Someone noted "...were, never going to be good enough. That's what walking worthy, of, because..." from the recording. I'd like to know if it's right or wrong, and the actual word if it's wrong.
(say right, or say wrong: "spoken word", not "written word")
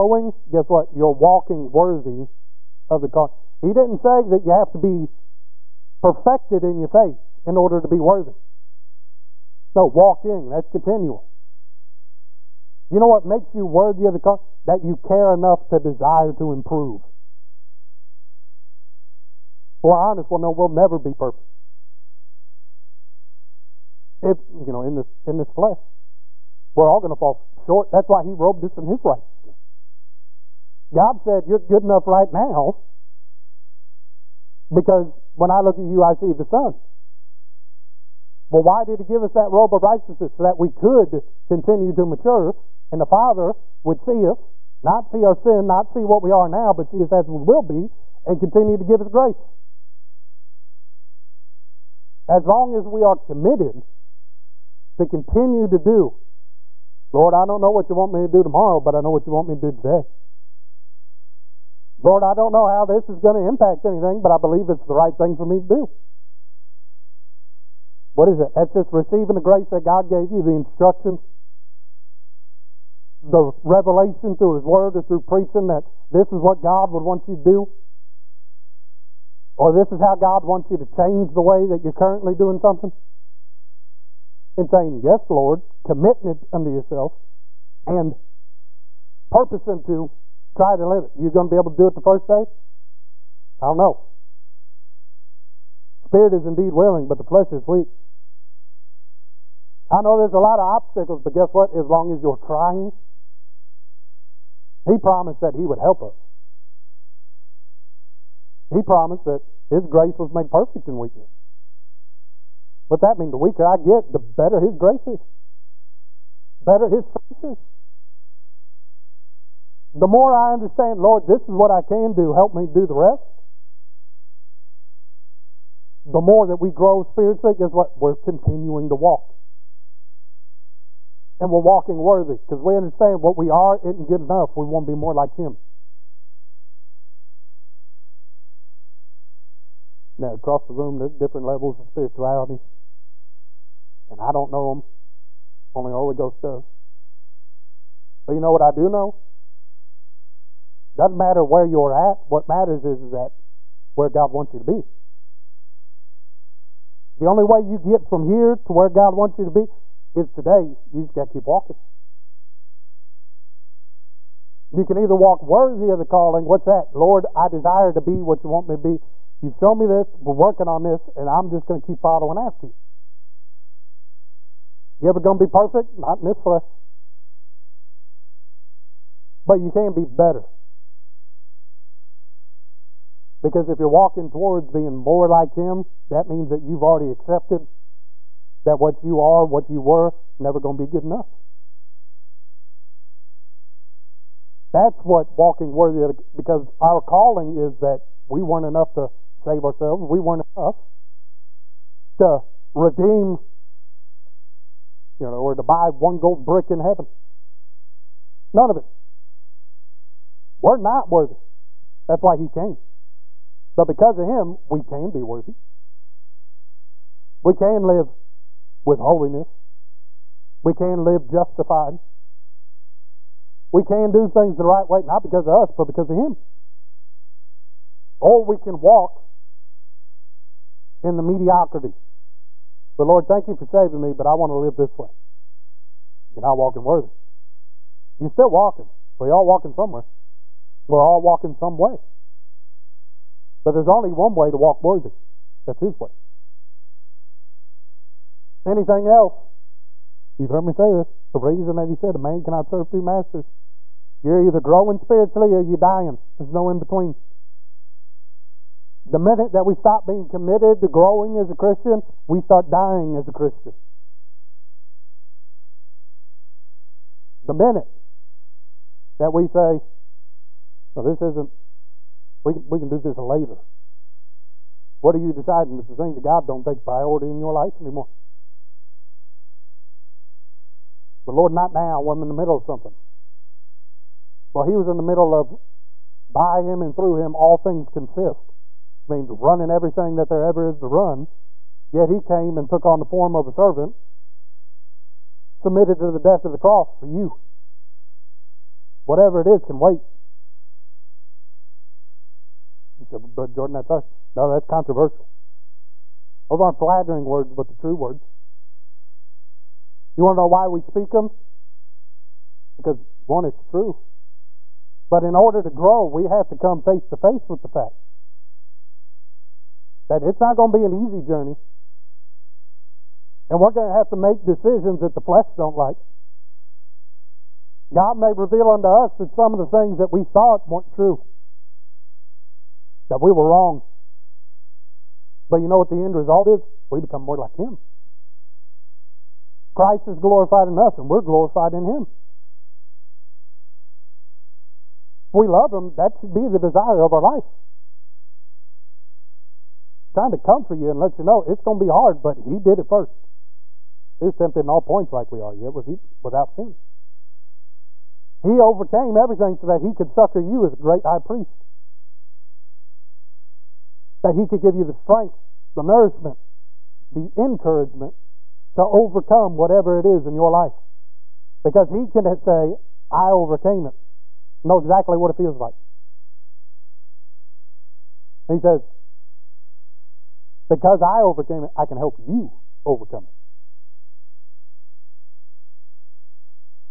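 right.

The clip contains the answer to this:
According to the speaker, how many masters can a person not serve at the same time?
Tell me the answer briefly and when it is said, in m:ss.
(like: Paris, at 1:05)
2, at 4:12.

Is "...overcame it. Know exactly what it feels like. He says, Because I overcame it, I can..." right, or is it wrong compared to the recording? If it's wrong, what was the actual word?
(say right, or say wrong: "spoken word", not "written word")
right.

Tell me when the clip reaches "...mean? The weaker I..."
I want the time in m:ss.
1:53.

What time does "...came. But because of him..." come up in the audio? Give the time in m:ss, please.
3:32.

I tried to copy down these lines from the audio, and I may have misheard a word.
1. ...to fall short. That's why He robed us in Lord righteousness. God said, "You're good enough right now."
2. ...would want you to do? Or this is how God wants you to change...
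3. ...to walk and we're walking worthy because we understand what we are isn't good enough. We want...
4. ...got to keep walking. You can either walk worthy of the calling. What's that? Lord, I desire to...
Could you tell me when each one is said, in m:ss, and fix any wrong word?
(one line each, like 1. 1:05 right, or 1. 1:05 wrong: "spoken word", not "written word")
1. 0:27 wrong: "His", not "Lord"
2. 1:16 right
3. 2:08 right
4. 2:41 right.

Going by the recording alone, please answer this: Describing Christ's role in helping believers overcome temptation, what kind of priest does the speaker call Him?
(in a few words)
Great high priest.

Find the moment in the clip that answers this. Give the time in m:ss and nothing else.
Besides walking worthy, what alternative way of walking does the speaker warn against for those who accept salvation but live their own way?
3:51.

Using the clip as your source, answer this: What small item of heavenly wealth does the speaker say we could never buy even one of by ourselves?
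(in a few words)
Gold brick.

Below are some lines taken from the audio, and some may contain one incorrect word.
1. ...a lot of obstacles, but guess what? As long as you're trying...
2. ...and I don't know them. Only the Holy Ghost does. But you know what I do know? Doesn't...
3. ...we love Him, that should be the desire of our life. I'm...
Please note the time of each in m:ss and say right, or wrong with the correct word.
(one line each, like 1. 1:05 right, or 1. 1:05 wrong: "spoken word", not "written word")
1. 1:40 right
2. 2:24 right
3. 5:45 right.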